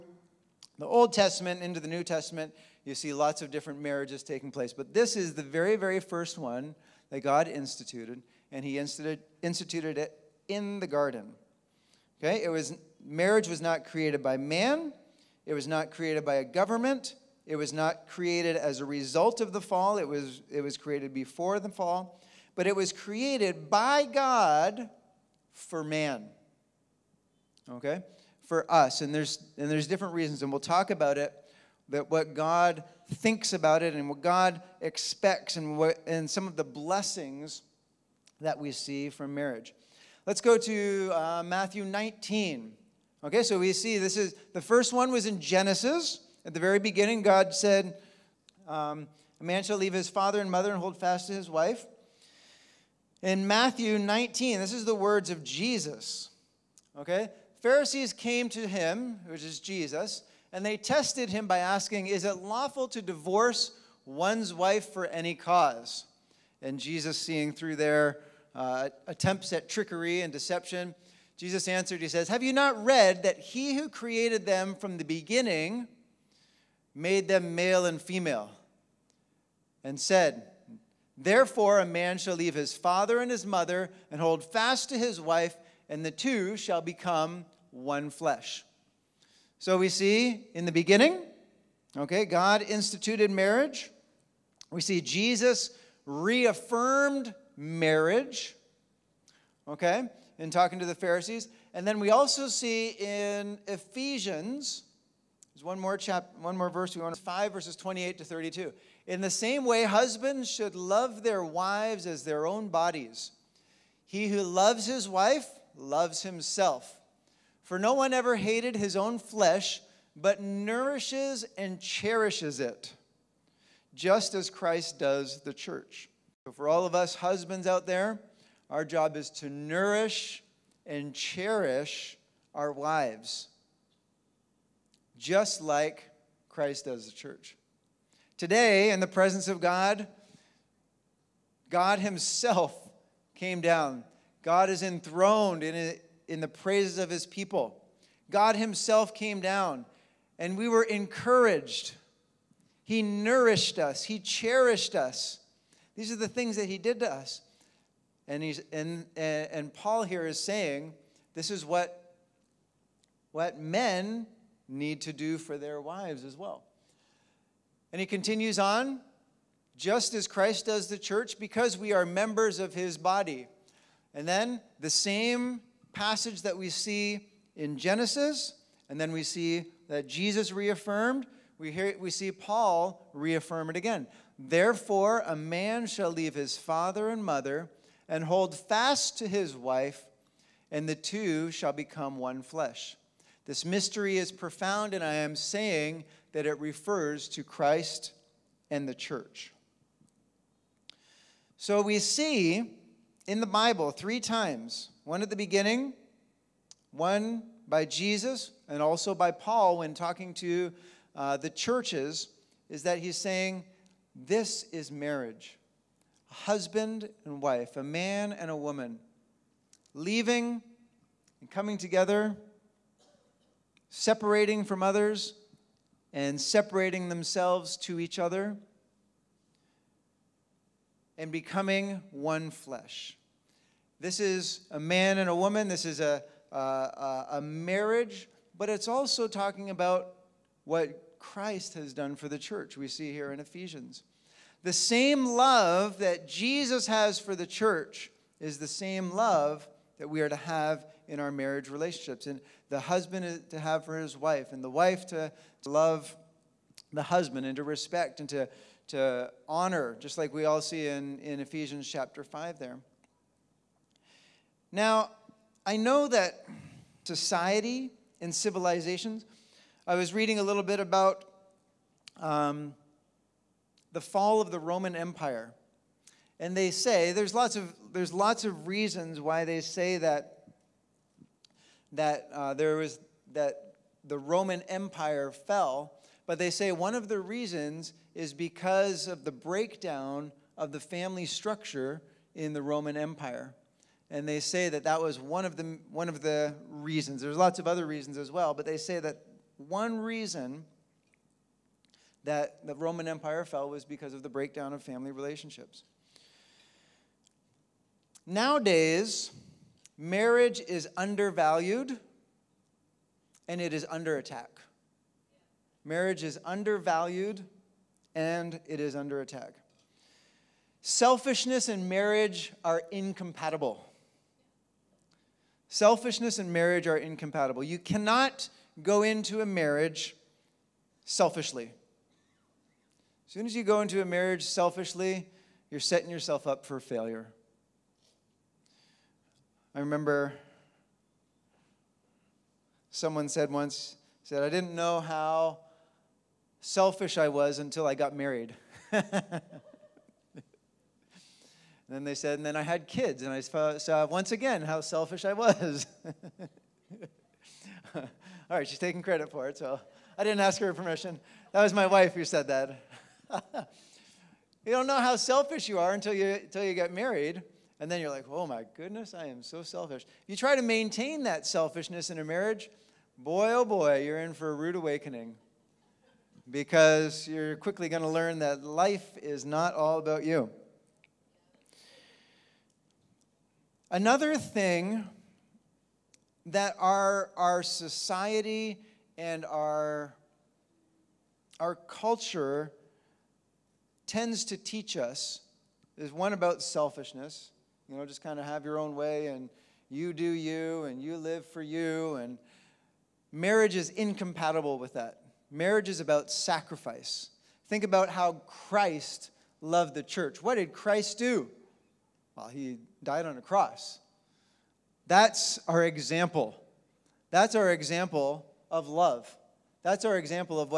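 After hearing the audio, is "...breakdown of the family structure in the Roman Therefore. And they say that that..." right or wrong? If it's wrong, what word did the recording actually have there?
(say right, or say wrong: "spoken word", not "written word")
wrong: "Empire", not "Therefore".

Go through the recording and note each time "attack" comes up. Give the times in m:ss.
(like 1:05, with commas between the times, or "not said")
5:14, 5:19.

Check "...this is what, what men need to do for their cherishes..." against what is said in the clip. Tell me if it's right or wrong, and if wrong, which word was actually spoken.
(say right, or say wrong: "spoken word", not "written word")
wrong: "wives", not "cherishes".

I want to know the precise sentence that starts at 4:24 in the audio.
Now, I know that society and civilizations, I was reading a little bit about um, the fall of the Roman Empire.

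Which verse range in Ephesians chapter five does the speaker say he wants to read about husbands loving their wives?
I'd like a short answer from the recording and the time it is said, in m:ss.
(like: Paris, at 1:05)
28 to 32, at 1:47.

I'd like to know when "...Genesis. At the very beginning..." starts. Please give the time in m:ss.
0:45.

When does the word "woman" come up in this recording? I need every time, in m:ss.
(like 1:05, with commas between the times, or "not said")
3:38, 3:55.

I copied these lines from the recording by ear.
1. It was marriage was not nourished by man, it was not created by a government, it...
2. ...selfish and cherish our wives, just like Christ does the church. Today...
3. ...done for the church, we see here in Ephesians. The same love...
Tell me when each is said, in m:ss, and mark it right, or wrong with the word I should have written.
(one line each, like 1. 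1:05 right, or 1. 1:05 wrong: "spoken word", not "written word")
1. 0:12 wrong: "created", not "nourished"
2. 2:09 wrong: "nourish", not "selfish"
3. 4:01 right.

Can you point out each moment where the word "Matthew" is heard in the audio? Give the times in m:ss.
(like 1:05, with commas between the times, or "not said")
0:41, 0:53.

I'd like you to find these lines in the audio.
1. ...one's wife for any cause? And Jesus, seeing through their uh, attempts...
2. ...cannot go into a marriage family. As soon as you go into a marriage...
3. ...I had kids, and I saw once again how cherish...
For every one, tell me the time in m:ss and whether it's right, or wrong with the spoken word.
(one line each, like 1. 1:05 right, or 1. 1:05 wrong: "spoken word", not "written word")
1. 1:04 right
2. 5:27 wrong: "selfishly", not "family"
3. 5:52 wrong: "selfish", not "cherish".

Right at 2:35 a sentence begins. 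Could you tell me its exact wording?
These are the things that he did to us.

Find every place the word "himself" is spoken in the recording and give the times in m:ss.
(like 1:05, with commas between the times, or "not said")
1:56, 2:21, 2:28.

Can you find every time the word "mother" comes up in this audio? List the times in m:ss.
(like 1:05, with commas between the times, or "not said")
0:50, 1:23, 3:07.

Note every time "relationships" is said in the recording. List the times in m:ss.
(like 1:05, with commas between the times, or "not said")
4:11, 5:05.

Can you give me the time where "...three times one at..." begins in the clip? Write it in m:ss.
3:23.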